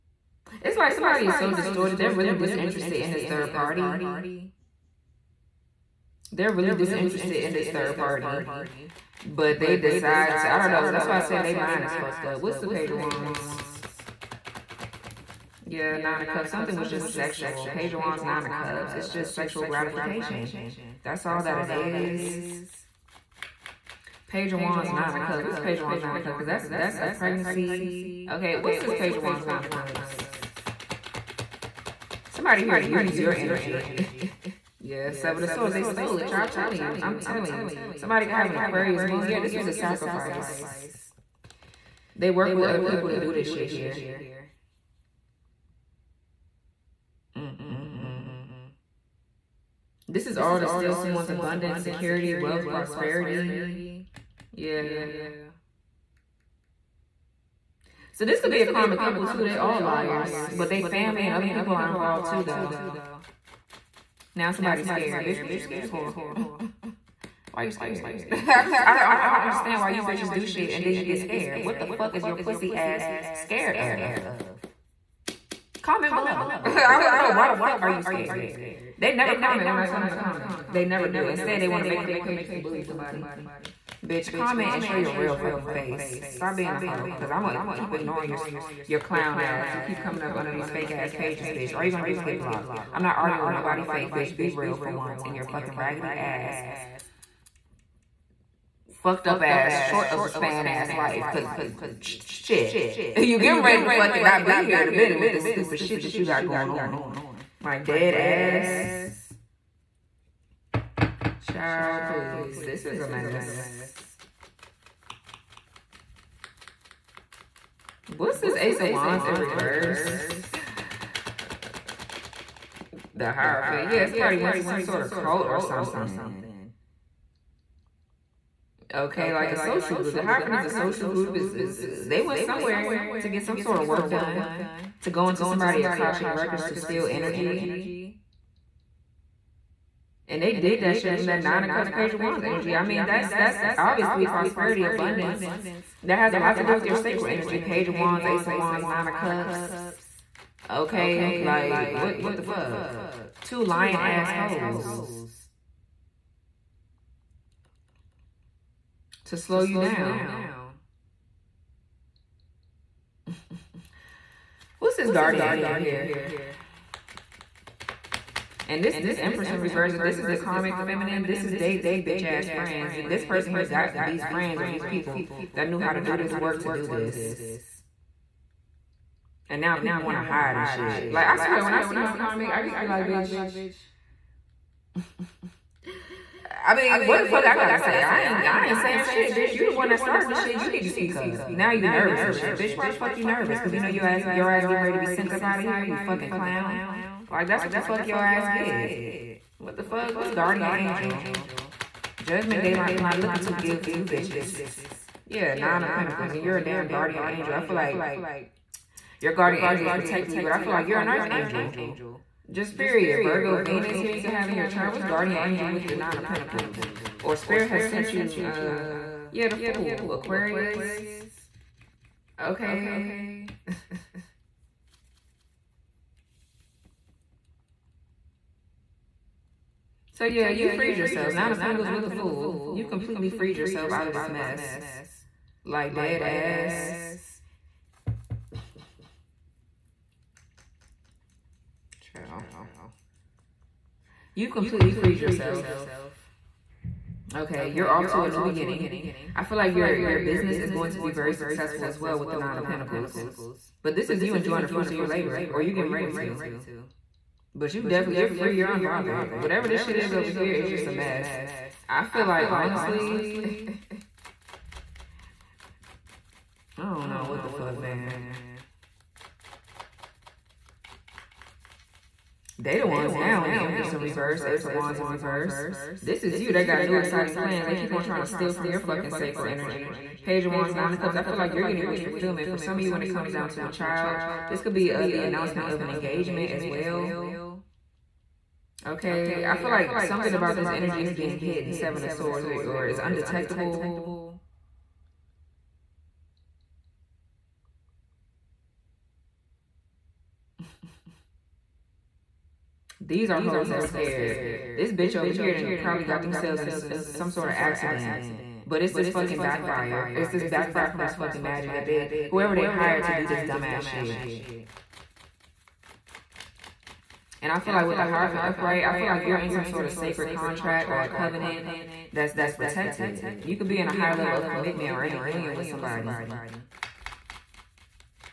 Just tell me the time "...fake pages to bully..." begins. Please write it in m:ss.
1:22.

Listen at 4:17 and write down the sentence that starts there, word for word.
But you definitely, you're free, you're unbothered.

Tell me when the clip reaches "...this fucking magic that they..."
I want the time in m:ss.
5:11.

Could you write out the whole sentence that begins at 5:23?
You could be in a higher level of commitment or in a union with somebody.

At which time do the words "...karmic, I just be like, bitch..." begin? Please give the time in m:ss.
3:02.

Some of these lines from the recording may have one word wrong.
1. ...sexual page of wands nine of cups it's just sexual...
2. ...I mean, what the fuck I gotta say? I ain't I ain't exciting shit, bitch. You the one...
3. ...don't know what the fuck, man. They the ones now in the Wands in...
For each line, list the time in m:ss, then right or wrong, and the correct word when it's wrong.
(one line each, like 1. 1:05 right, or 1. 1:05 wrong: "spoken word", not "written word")
1. 0:17 right
2. 3:06 wrong: "saying", not "exciting"
3. 4:26 wrong: "Empress", not "Wands".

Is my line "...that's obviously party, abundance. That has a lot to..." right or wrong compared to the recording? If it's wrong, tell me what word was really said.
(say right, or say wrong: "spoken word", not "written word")
wrong: "prosperity", not "party".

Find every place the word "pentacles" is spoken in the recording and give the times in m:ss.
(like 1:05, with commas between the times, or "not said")
3:25, 3:36, 3:51, 4:12.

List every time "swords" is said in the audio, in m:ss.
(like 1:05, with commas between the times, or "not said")
0:35, 4:52.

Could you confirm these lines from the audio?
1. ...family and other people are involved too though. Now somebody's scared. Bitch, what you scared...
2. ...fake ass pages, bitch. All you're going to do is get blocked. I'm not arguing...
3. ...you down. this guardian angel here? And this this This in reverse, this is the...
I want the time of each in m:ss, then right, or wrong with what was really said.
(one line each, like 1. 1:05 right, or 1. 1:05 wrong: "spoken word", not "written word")
1. 1:00 right
2. 1:30 right
3. 2:39 wrong: "Empress", not "This".